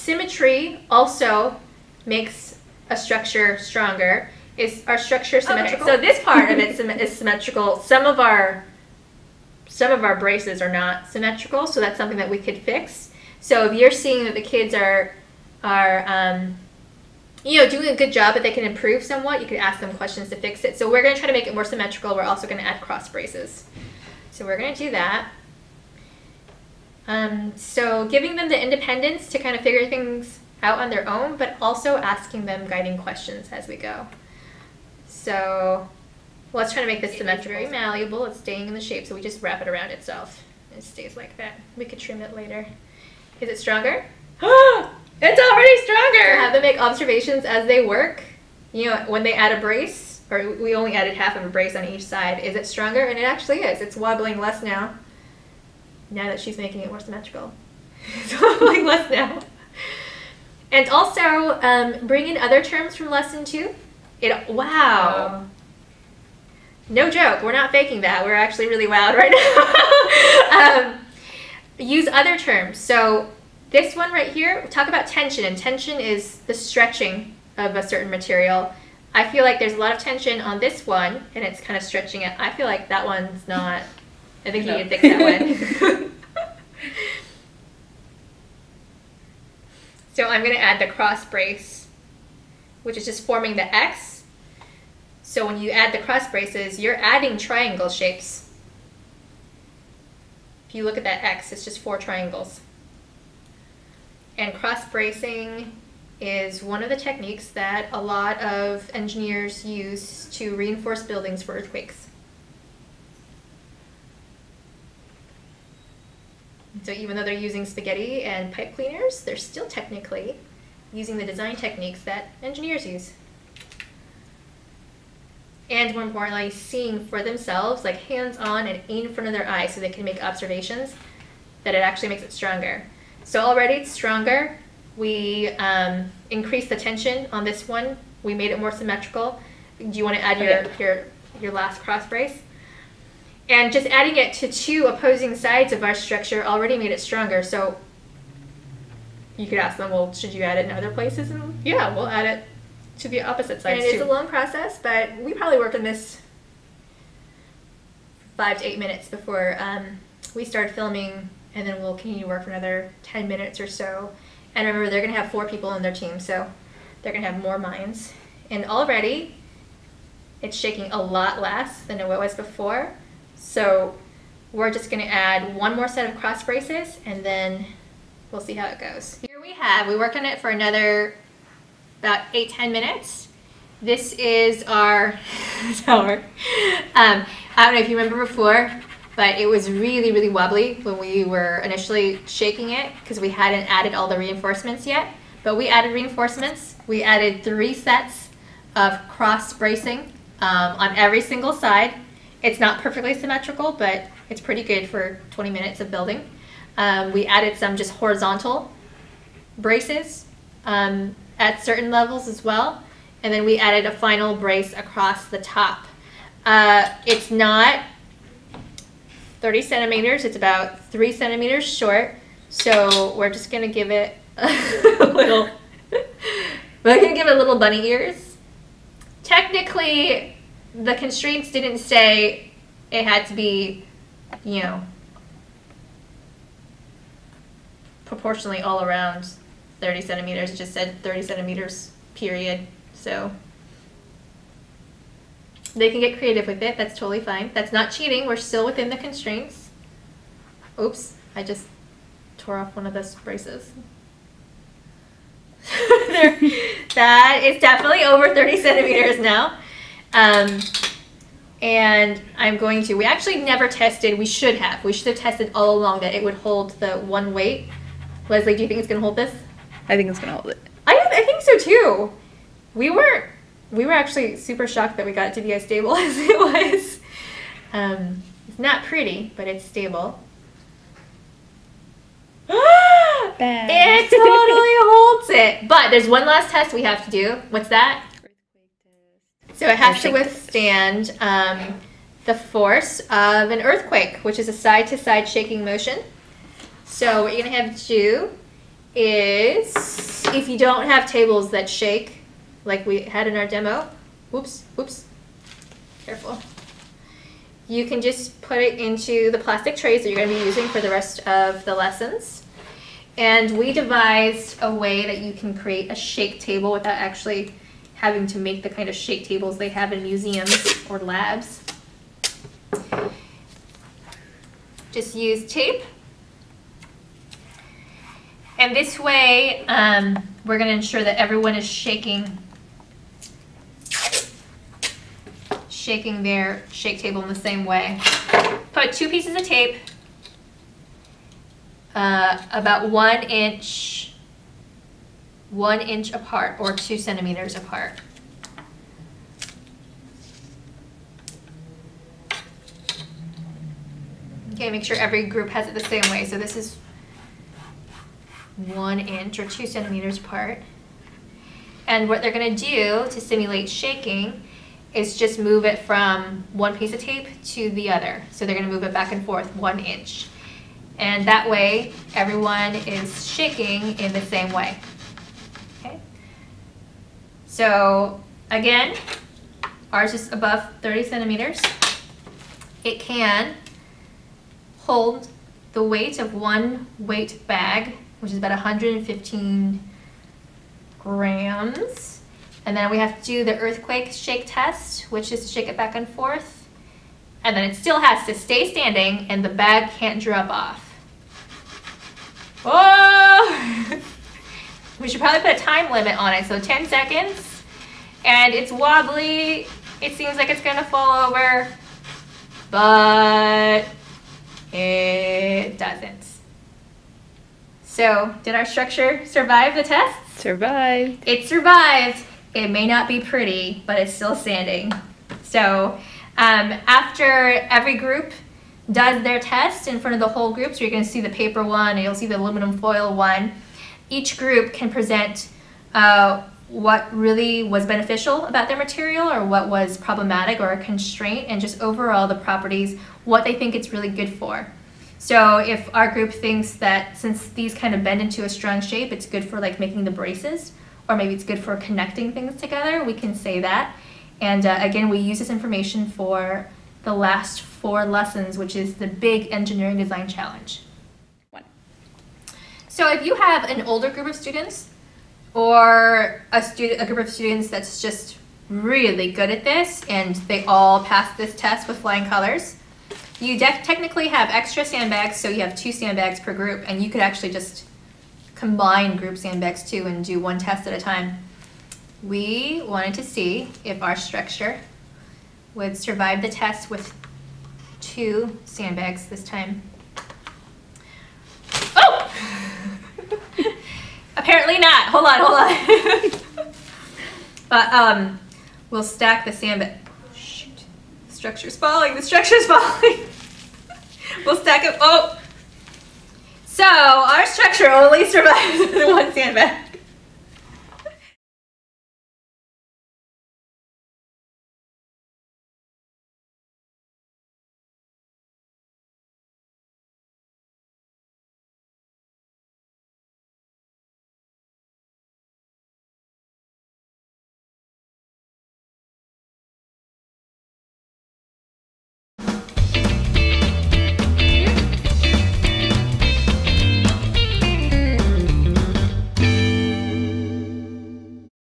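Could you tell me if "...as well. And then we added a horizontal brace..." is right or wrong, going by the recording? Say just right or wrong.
wrong.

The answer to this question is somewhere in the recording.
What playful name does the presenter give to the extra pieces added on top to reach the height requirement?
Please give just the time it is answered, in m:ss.
3:47.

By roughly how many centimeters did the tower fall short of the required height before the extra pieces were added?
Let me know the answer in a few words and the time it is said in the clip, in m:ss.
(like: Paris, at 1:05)
3 centimeters, at 3:40.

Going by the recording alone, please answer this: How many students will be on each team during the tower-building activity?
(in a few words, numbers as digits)
4.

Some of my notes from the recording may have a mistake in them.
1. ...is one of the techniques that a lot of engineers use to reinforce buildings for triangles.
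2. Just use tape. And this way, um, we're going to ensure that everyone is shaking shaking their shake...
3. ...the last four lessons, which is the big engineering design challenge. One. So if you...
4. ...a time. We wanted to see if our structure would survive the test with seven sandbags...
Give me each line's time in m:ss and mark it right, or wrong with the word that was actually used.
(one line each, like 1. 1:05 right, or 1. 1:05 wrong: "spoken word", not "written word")
1. 1:46 wrong: "earthquakes", not "triangles"
2. 5:24 right
3. 7:37 right
4. 8:00 wrong: "two", not "seven".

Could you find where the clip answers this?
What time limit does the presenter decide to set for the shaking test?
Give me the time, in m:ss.
6:46.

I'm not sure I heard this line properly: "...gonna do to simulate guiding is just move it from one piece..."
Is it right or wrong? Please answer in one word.
wrong.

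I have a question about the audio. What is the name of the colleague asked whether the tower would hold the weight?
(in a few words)
Leslie.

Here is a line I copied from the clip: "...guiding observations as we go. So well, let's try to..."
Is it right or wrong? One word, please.
wrong.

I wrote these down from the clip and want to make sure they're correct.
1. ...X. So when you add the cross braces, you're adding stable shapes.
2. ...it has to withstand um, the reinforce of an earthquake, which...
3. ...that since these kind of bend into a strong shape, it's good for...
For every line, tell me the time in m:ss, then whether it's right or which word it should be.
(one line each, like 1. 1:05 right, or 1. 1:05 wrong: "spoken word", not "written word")
1. 1:33 wrong: "triangle", not "stable"
2. 4:49 wrong: "force", not "reinforce"
3. 7:26 right.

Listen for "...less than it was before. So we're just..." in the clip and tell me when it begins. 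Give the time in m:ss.
2:51.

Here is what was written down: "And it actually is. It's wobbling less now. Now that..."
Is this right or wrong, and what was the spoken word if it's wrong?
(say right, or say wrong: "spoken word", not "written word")
right.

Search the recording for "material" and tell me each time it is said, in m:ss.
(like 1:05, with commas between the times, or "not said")
1:18, 7:18.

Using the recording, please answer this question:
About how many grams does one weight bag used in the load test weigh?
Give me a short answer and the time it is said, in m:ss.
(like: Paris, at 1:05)
115 grams, at 6:28.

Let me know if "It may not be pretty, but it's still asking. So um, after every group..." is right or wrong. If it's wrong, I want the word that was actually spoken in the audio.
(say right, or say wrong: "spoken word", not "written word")
wrong: "standing", not "asking".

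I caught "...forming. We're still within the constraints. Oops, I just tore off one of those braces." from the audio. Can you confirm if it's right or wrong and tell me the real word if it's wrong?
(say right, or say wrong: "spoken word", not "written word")
wrong: "cheating", not "forming".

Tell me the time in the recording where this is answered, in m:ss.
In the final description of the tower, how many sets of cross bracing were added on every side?
3:17.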